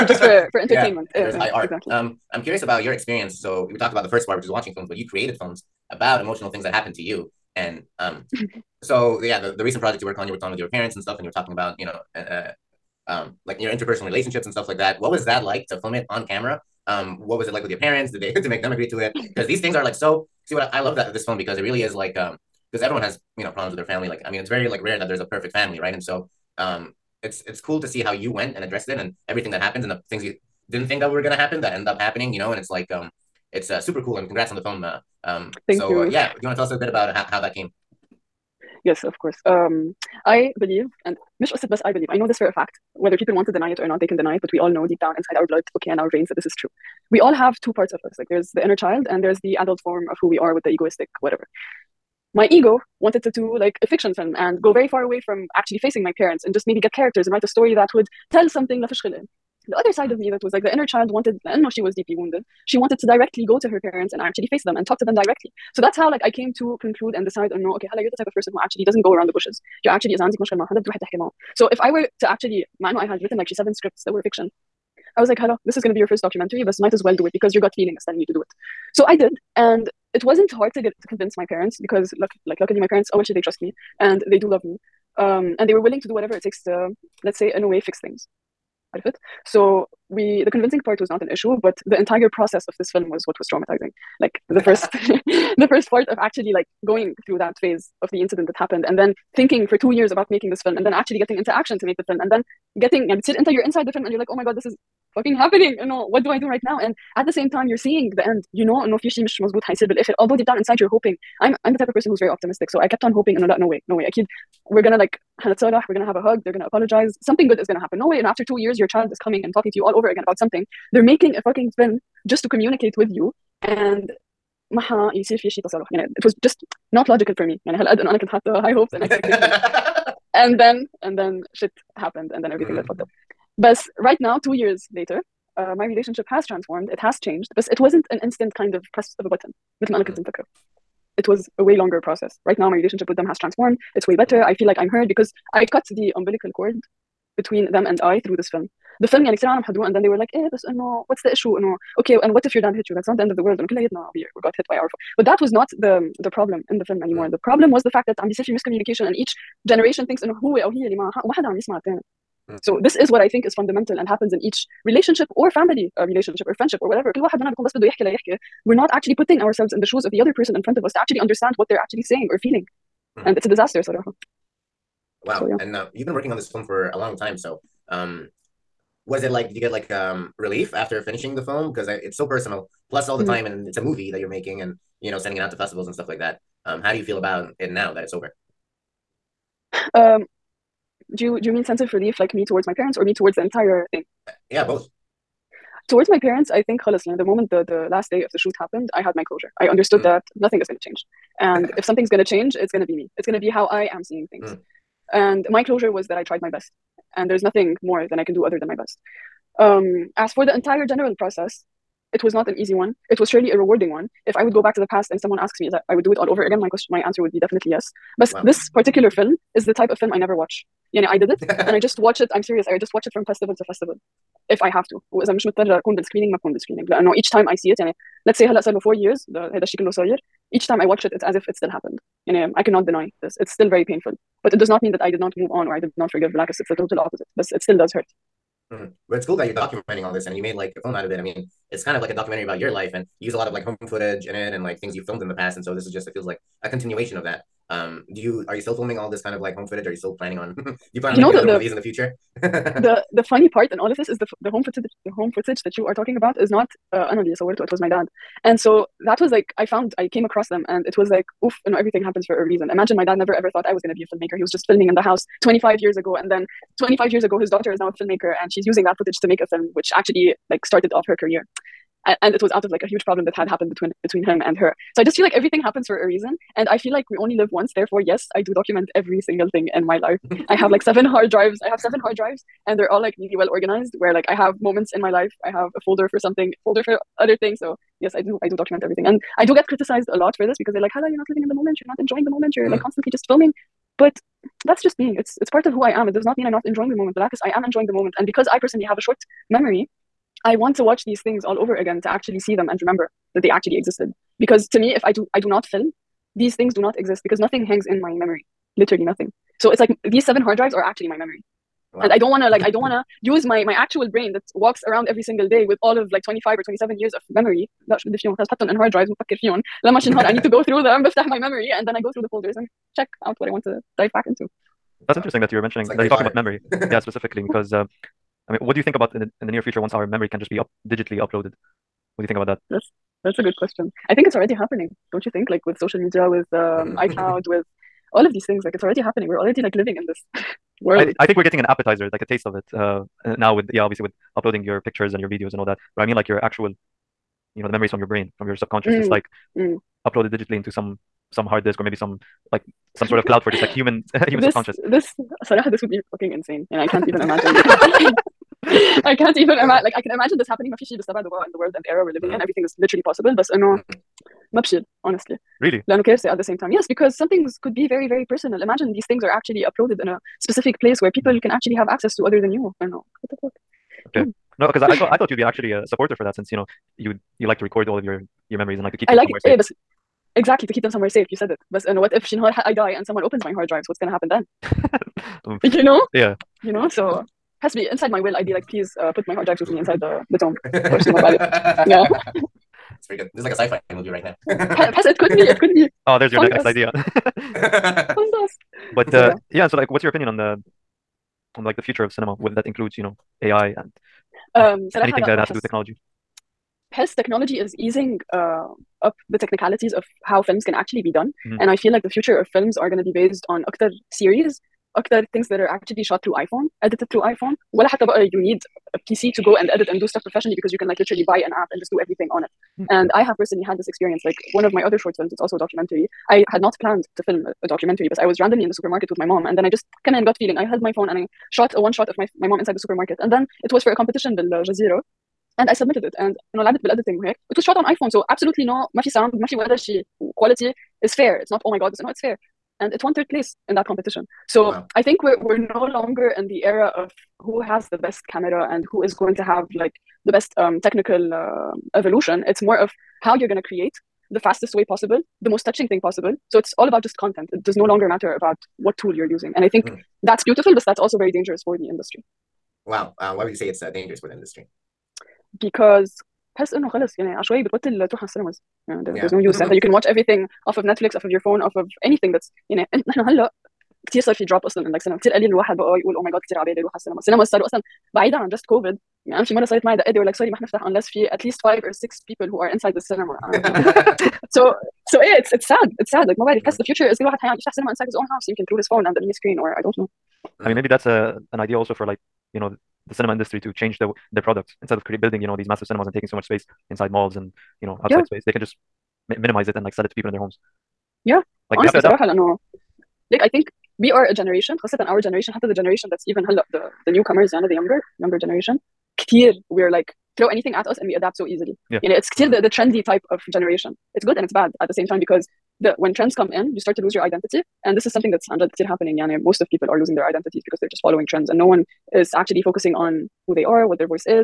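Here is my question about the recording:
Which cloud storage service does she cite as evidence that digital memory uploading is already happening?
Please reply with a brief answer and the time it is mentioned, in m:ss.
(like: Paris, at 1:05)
iCloud, at 5:36.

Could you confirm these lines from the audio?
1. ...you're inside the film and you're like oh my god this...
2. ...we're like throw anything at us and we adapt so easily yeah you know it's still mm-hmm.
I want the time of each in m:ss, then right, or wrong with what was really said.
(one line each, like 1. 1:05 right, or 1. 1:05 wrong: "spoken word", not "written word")
1. 1:43 right
2. 8:29 right.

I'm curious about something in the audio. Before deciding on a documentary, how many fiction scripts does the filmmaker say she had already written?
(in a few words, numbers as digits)
7.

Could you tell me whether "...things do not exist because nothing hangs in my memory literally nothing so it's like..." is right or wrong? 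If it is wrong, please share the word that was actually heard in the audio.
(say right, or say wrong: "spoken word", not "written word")
right.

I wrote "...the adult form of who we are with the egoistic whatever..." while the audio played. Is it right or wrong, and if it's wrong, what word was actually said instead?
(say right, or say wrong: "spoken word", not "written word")
right.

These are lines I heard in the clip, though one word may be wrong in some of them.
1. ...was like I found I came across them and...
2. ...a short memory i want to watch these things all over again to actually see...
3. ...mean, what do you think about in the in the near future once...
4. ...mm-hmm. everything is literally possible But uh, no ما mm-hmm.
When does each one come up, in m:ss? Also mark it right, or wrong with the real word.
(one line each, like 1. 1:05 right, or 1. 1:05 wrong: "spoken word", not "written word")
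1. 4:19 right
2. 4:58 right
3. 5:28 right
4. 6:02 right.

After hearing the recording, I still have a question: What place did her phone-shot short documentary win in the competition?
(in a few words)
third place.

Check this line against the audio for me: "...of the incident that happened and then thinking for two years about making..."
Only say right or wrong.
right.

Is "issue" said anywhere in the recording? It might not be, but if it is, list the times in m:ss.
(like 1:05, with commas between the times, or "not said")
1:31, 2:31.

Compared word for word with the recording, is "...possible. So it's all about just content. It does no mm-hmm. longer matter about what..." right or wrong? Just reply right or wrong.
right.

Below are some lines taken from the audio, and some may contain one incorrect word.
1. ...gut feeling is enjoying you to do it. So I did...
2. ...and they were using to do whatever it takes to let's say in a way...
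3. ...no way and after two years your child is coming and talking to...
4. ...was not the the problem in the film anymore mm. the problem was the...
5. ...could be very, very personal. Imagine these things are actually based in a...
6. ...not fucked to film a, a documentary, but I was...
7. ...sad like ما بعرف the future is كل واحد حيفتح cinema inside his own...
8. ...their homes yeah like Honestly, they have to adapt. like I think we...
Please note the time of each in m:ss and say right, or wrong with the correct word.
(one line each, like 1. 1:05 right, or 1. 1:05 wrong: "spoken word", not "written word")
1. 1:17 wrong: "telling", not "enjoying"
2. 1:25 wrong: "willing", not "using"
3. 1:57 right
4. 2:35 right
5. 6:07 wrong: "uploaded", not "based"
6. 7:06 wrong: "planned", not "fucked"
7. 8:06 right
8. 8:20 right.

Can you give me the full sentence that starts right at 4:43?
Where like I have moments in my life, I have a folder for something, folder for other things.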